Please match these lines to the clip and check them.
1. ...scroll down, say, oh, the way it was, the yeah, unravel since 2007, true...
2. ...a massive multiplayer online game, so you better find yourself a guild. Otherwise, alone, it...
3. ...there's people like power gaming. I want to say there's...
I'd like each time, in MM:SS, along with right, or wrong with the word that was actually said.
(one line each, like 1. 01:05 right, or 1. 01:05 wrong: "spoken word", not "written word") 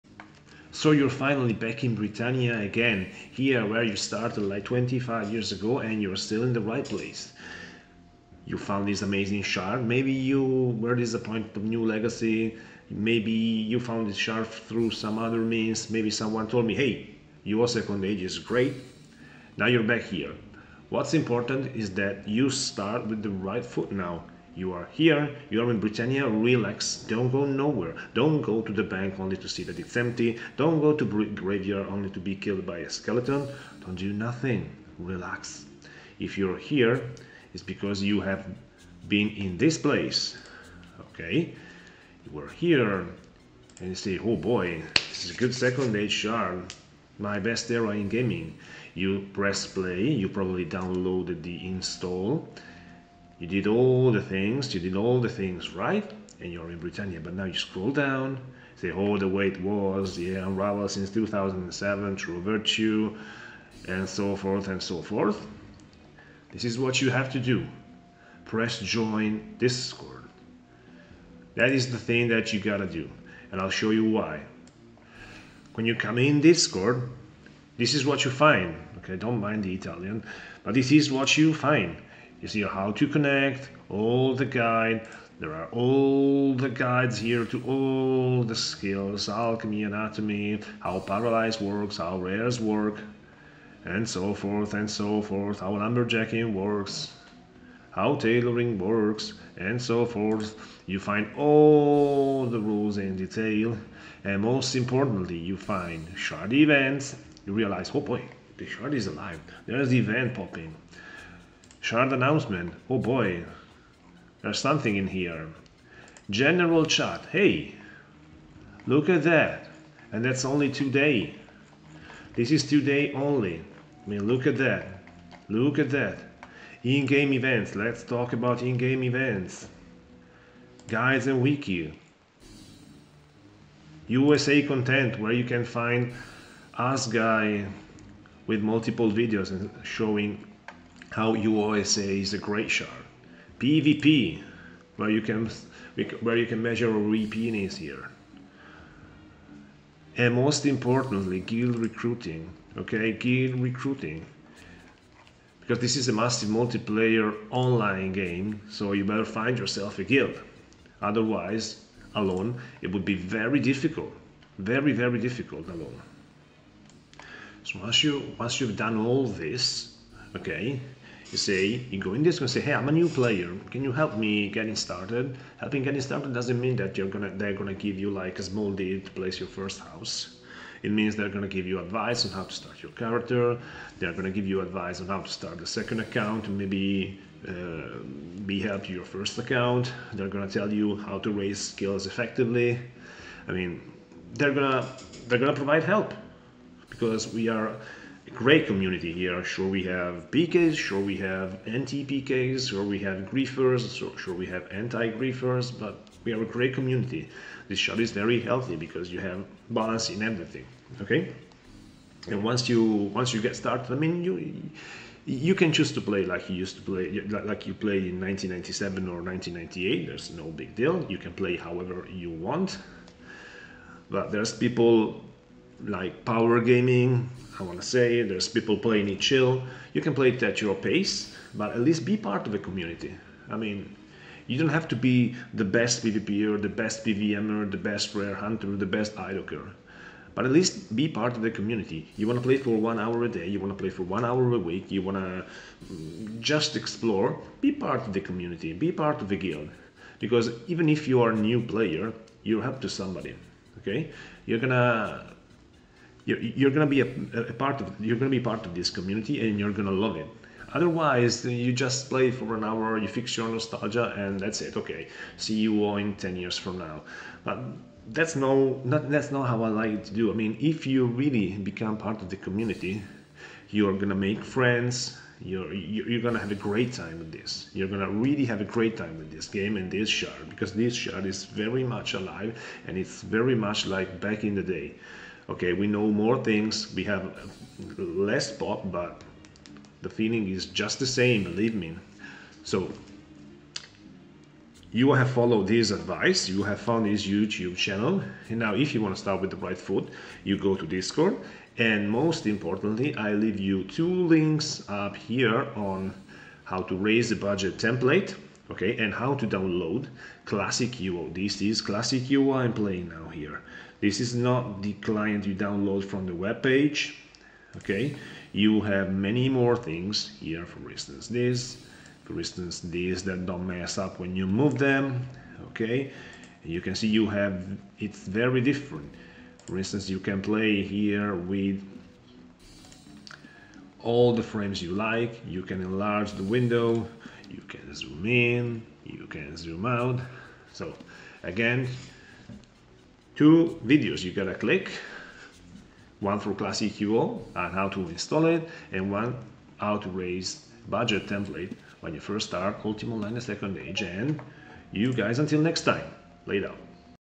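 1. 00:57 right
2. 02:36 right
3. 03:44 right.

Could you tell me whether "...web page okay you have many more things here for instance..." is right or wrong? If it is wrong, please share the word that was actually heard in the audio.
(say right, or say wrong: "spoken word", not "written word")
right.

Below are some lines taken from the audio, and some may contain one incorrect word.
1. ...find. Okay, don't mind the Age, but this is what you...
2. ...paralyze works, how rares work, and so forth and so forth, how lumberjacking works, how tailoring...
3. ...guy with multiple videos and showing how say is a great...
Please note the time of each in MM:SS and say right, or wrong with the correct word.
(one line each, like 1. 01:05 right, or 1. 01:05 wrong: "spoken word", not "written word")
1. 01:18 wrong: "Italian", not "Age"
2. 01:31 right
3. 02:17 right.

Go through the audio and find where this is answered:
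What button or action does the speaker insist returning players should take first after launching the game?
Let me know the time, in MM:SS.
01:08.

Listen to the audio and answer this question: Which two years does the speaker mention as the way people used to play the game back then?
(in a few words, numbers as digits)
1997 or 1998.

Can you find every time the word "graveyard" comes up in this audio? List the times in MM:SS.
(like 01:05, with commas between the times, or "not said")
00:31.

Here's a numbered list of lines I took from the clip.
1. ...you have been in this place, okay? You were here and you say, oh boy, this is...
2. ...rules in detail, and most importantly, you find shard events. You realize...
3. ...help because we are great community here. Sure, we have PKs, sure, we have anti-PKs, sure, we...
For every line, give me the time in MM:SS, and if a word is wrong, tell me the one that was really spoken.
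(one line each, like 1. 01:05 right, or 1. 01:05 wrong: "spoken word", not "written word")
1. 00:38 right
2. 01:42 right
3. 03:15 right.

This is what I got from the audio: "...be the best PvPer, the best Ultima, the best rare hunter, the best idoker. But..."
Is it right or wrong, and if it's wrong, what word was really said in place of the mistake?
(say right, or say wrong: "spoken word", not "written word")
wrong: "PVMer", not "Ultima".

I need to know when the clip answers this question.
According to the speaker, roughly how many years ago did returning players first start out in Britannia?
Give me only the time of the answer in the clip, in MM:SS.
00:04.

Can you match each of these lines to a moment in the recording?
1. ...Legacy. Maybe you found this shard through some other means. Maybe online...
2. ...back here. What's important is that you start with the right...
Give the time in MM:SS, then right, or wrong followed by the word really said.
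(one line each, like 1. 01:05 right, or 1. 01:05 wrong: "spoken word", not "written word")
1. 00:11 wrong: "someone", not "online"
2. 00:19 right.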